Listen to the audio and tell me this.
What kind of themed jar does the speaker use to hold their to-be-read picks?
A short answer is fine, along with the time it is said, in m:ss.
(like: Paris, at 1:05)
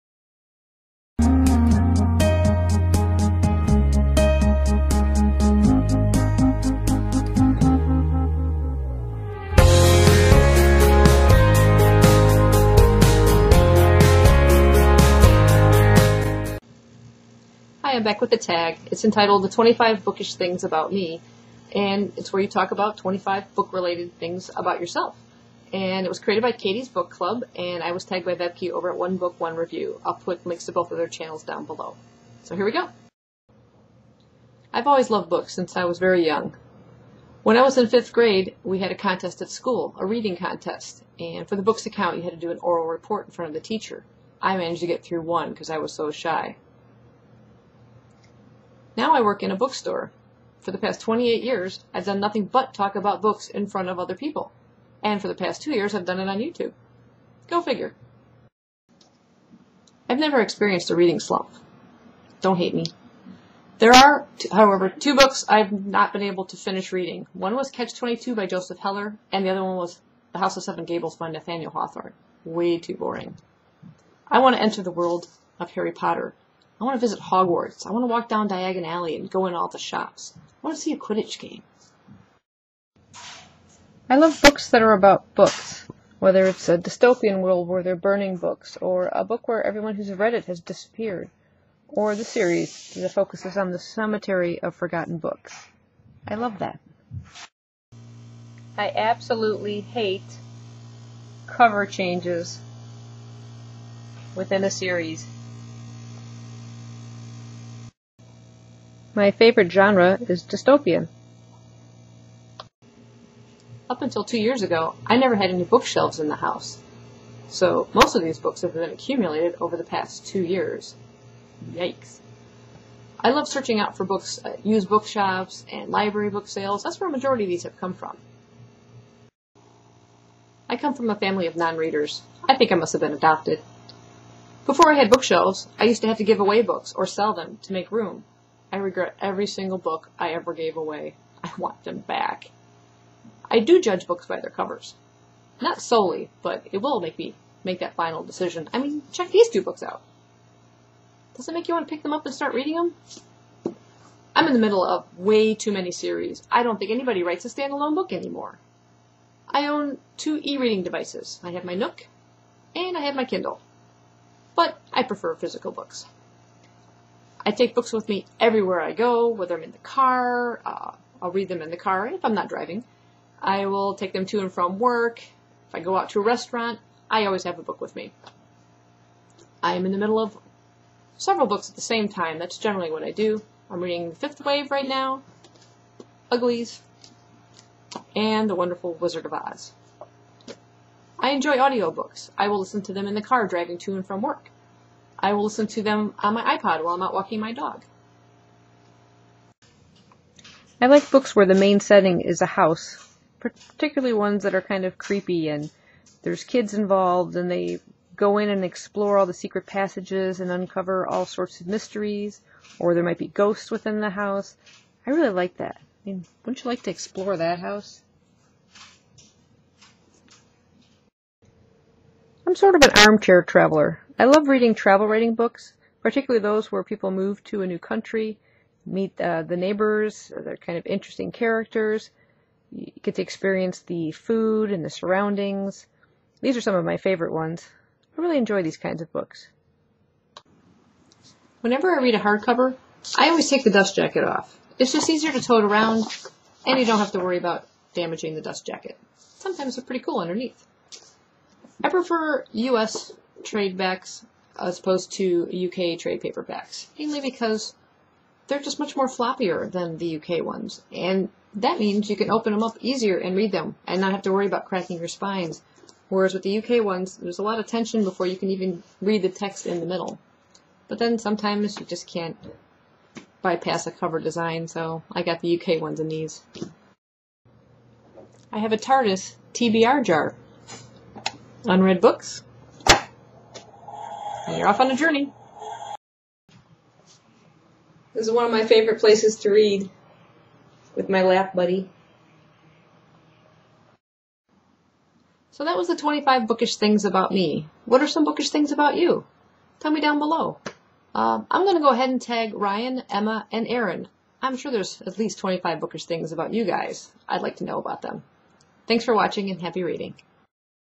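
TARDIS, at 4:38.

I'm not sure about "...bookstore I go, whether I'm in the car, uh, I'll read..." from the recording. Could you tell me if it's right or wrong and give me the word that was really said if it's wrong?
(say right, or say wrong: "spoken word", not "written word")
wrong: "everywhere", not "bookstore".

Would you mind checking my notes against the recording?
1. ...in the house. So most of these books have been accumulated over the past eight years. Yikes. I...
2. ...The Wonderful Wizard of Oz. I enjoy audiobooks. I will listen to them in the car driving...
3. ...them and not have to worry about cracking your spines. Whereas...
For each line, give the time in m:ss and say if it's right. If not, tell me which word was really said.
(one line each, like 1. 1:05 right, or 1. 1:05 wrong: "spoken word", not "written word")
1. 1:56 wrong: "two", not "eight"
2. 3:08 right
3. 4:23 right.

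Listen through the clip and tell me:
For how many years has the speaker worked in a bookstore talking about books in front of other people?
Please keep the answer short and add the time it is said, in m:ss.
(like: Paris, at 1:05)
28, at 0:51.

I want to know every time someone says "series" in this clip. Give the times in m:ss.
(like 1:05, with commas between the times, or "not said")
1:32, 1:44, 2:35.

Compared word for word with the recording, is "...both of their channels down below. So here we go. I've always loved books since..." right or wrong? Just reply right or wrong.
right.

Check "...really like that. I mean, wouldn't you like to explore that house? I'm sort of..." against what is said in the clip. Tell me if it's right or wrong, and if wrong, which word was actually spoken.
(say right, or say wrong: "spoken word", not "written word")
right.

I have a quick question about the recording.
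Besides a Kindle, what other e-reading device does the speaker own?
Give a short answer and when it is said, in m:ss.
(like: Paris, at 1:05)
Nook, at 2:41.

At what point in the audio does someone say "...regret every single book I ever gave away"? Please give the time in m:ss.
2:18.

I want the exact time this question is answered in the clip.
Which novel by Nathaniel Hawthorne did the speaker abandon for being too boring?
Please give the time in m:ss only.
1:10.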